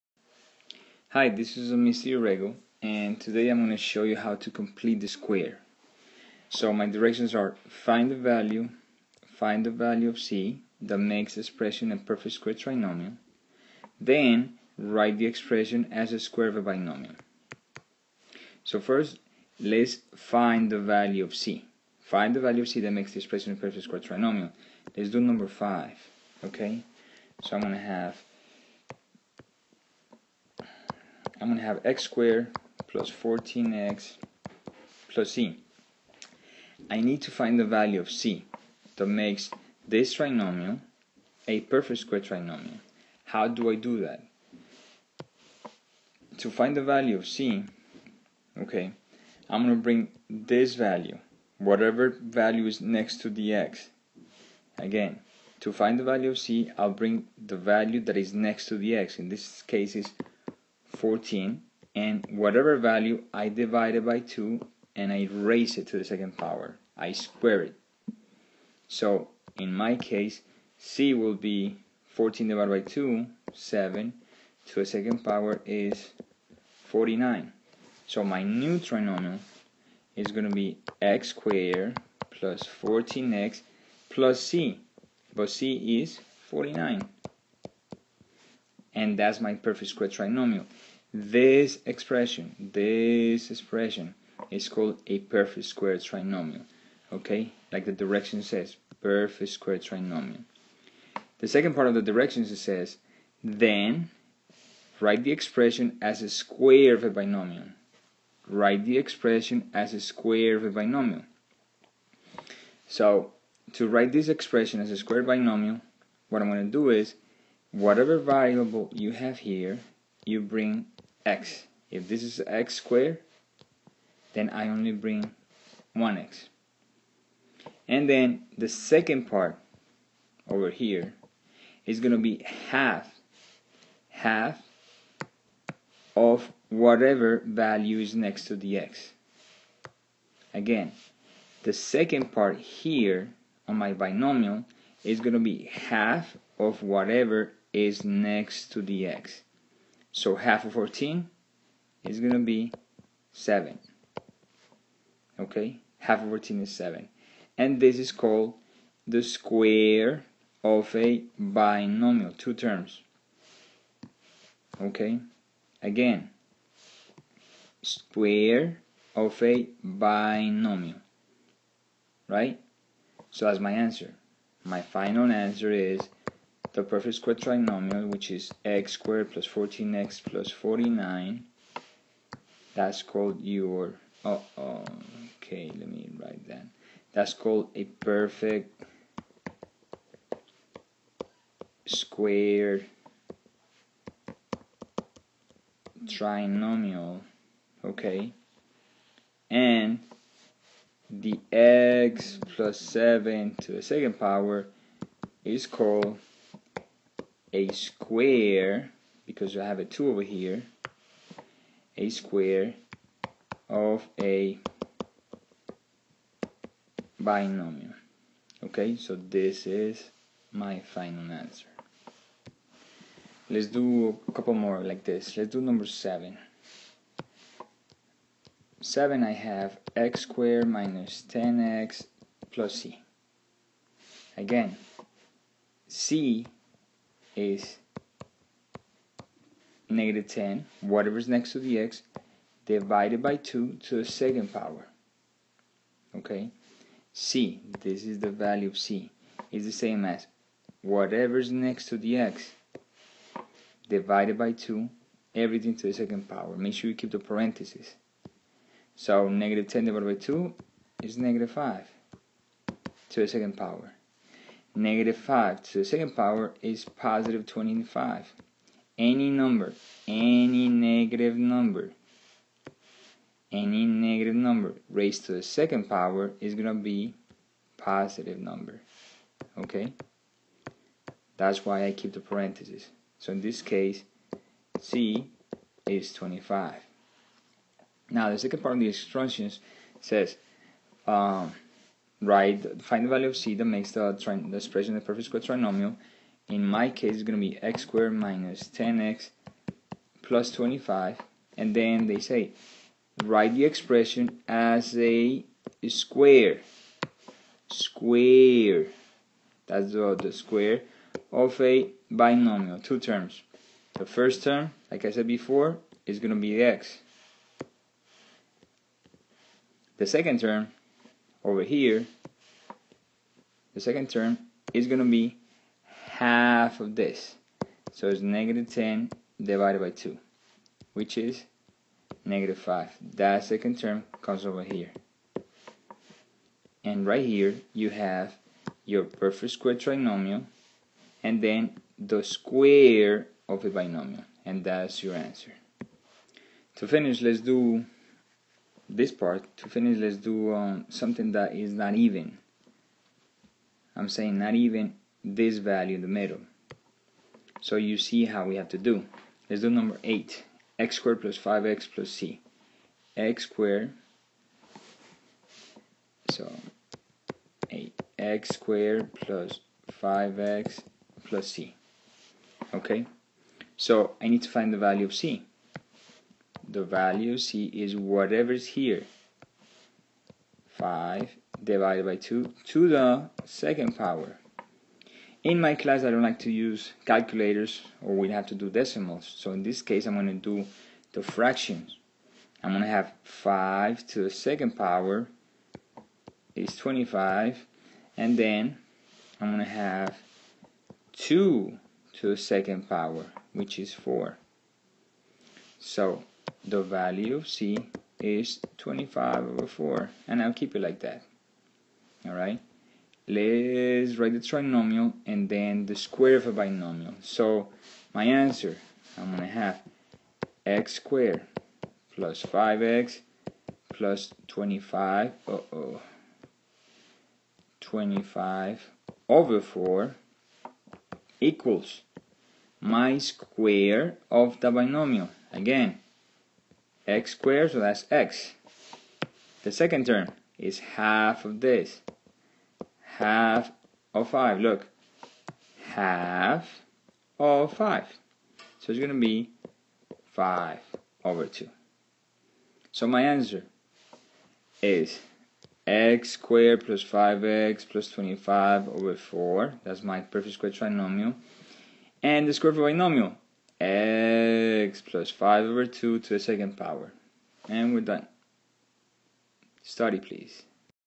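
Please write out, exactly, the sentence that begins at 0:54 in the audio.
Again, to find the value of c, I'll bring the value that is next to the x.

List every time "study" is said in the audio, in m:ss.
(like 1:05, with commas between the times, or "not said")
7:49.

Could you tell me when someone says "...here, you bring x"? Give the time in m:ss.
1:59.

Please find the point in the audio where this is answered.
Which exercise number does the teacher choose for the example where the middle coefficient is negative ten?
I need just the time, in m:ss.
3:45.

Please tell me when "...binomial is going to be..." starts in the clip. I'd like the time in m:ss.
2:23.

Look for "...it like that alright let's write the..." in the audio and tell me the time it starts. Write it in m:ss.
6:50.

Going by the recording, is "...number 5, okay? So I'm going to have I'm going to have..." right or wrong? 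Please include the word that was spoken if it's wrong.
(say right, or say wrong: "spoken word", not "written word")
right.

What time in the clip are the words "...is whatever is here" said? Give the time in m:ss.
6:17.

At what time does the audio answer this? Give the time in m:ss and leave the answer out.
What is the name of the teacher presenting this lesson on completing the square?
0:01.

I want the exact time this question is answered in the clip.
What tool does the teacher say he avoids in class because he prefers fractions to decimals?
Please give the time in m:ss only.
6:27.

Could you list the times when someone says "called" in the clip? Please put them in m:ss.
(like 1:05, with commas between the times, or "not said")
1:34, 2:38, 3:03, 3:07, 3:25.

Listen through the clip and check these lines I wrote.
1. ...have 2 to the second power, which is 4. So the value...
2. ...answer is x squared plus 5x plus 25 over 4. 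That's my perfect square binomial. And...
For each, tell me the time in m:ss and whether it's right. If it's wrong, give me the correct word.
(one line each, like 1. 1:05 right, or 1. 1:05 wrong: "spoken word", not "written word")
1. 6:39 right
2. 7:33 wrong: "trinomial", not "binomial".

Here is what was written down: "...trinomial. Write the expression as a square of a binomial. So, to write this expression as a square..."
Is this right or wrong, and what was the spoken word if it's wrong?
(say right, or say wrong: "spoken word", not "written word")
wrong: "binomial", not "trinomial".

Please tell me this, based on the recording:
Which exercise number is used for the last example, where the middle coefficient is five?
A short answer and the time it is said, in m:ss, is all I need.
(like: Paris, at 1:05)
8, at 5:59.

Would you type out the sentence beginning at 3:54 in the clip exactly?
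Again, c is negative 10, whatever's next to the x, divided by 2 to the second power.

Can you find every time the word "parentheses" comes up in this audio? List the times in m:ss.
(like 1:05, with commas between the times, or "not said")
4:17, 4:42.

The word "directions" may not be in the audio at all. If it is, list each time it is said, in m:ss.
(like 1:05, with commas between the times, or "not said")
0:06, 1:37, 1:42.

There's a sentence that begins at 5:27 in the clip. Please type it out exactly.
So it's negative 10 divided by 2, which is negative 5.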